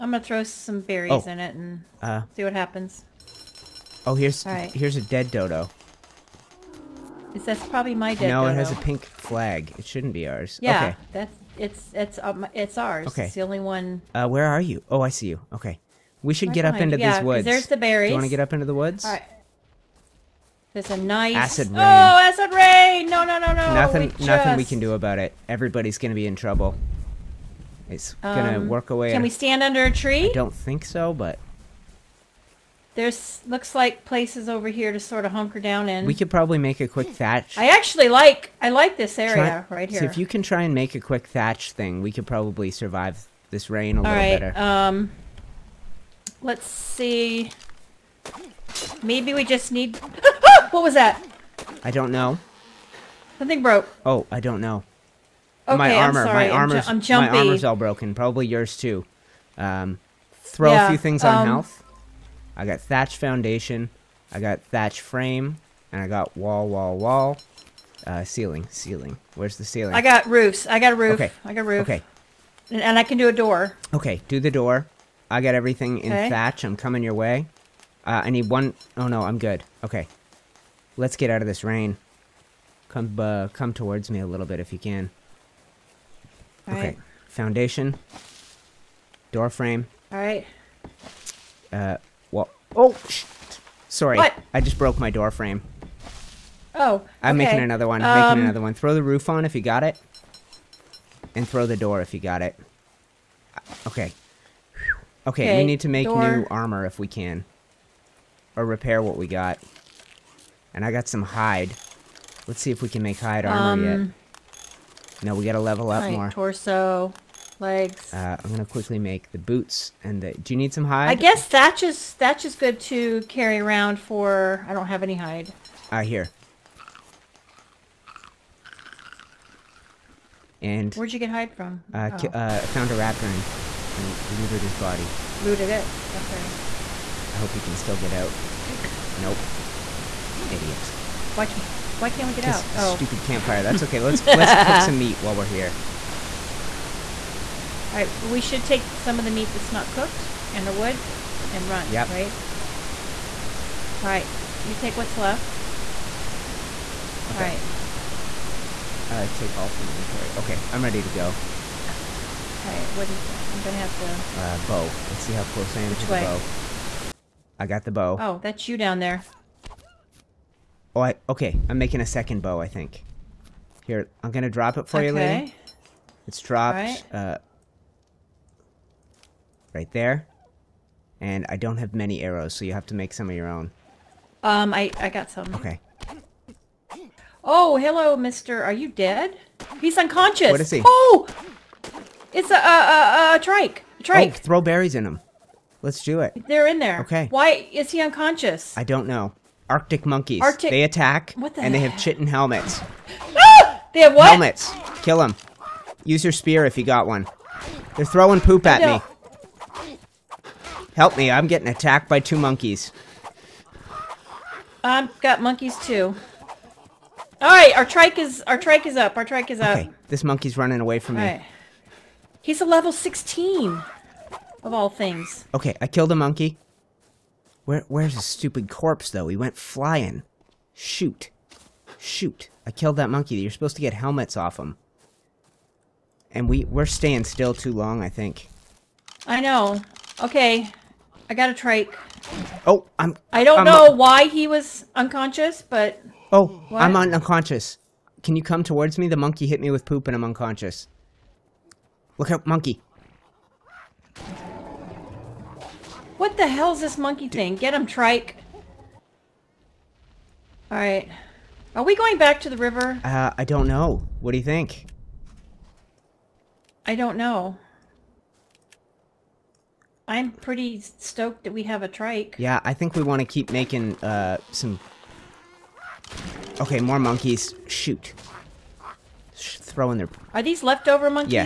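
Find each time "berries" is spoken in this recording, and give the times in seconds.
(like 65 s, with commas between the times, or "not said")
0 s, 17 s, 194 s.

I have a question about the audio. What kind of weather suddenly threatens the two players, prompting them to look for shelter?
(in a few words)
Acid rain.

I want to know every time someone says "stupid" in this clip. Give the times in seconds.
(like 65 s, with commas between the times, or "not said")
142 s, 228 s.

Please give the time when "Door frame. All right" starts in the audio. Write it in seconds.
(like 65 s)
89 s.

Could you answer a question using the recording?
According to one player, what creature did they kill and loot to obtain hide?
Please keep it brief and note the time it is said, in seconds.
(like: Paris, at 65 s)
A raptor, at 132 s.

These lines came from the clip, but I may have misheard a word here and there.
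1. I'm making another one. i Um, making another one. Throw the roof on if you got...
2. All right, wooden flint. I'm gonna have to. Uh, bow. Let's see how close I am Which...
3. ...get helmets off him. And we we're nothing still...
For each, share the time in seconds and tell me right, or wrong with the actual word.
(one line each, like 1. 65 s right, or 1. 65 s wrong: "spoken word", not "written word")
1. 97 s right
2. 161 s right
3. 233 s wrong: "staying", not "nothing".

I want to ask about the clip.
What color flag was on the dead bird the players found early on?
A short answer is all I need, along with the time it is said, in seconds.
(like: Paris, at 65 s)
Pink, at 8 s.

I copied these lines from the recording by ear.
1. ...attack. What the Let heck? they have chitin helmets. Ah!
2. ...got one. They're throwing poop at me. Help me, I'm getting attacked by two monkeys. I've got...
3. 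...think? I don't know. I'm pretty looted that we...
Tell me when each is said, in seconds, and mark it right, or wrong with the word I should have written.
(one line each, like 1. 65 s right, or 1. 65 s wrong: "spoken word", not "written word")
1. 200 s wrong: "And", not "Let"
2. 206 s right
3. 264 s wrong: "stoked", not "looted".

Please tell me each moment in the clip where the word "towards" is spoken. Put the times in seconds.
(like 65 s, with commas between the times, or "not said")
83 s, 248 s.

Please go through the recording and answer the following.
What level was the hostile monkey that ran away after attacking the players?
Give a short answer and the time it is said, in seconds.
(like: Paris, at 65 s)
16, at 222 s.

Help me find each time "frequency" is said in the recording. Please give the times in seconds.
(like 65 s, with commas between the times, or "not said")
not said.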